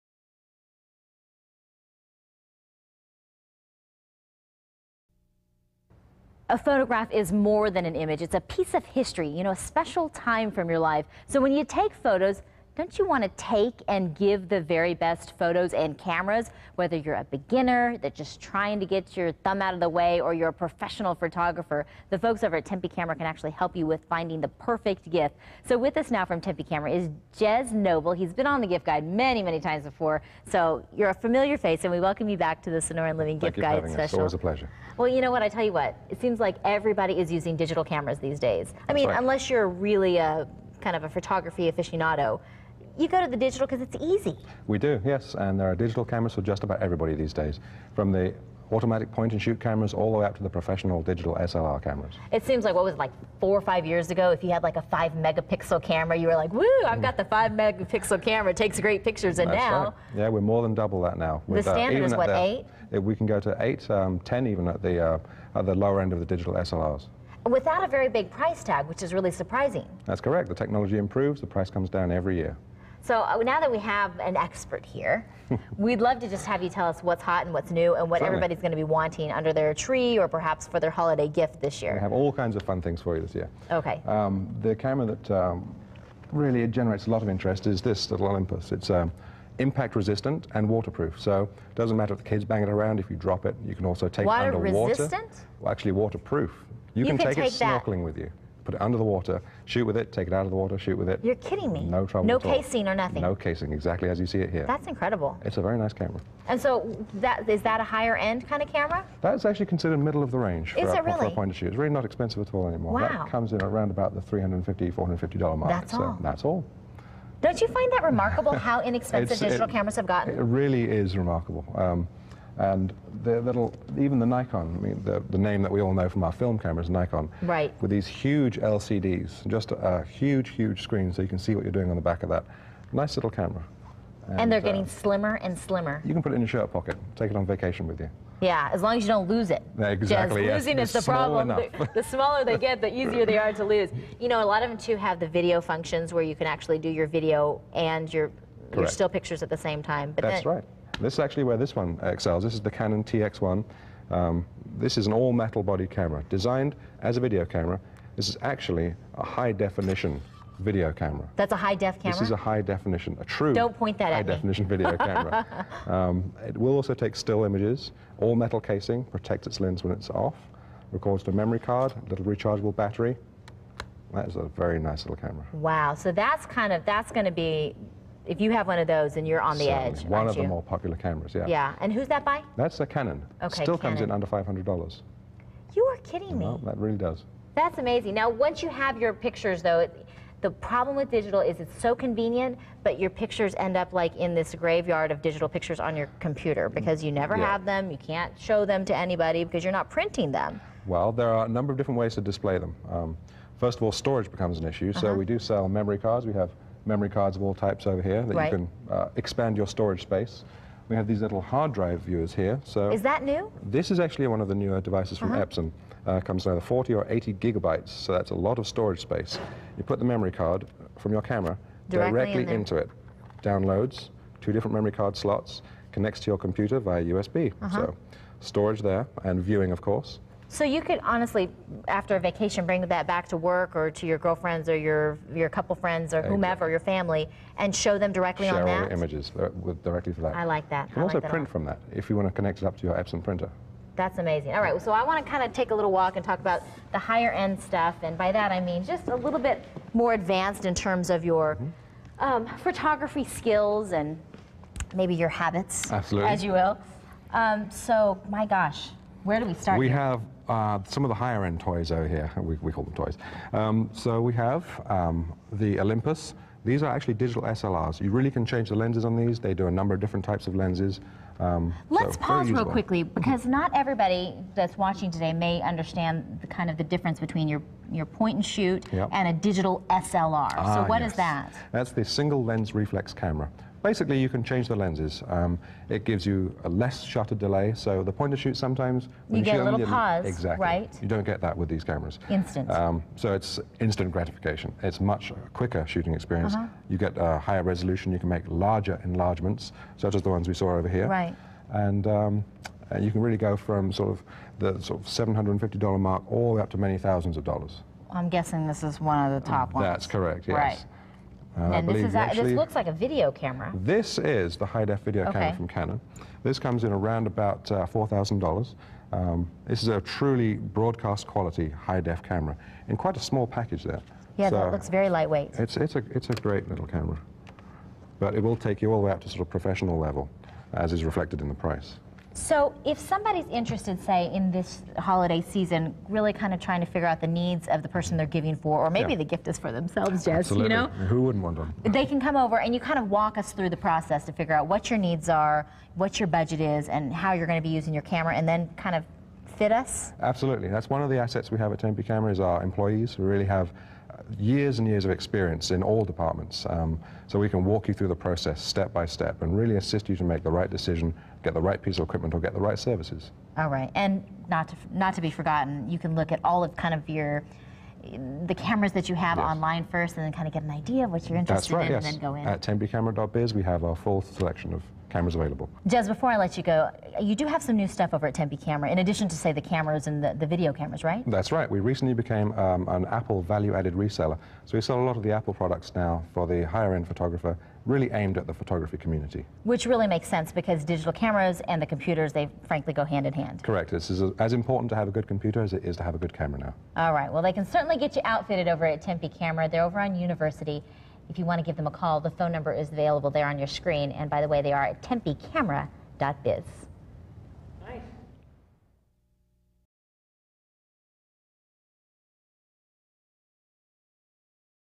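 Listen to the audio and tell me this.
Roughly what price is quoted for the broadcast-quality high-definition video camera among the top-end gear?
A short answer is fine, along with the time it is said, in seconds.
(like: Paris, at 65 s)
$4,000, at 317 s.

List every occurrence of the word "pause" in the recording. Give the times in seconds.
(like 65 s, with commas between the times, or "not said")
272 s, 289 s.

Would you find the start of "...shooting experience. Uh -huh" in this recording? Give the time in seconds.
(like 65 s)
295 s.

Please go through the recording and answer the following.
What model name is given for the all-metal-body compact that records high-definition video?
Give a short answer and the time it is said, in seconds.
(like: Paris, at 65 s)
Canon TX1, at 152 s.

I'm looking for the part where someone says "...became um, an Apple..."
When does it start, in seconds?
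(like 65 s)
382 s.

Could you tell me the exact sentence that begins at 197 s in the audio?
have them, you can't show them to anybody because you're not printing them.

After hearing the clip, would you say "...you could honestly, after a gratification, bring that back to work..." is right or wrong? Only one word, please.
wrong.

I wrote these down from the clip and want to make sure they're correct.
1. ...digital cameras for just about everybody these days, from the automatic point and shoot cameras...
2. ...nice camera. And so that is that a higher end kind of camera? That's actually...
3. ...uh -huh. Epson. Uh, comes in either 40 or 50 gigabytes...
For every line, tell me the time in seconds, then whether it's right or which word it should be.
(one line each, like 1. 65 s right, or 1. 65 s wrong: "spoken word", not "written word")
1. 45 s right
2. 105 s right
3. 215 s wrong: "80", not "50".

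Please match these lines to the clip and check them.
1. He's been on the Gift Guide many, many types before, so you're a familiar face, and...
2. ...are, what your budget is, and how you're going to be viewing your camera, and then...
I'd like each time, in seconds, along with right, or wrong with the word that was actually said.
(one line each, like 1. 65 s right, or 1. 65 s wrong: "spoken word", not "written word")
1. 28 s wrong: "times", not "types"
2. 345 s wrong: "using", not "viewing".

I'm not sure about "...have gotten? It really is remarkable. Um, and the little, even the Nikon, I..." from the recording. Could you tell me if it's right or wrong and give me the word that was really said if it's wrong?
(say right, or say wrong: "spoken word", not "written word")
right.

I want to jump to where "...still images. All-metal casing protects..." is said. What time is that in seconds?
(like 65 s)
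167 s.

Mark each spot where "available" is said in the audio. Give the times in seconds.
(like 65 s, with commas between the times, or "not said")
375 s, 402 s.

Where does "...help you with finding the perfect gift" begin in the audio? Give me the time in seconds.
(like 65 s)
23 s.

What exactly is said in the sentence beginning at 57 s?
got the five megapixel camera, it takes great pictures, and That's now.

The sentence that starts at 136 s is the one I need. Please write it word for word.
You can put it in your shirt pocket.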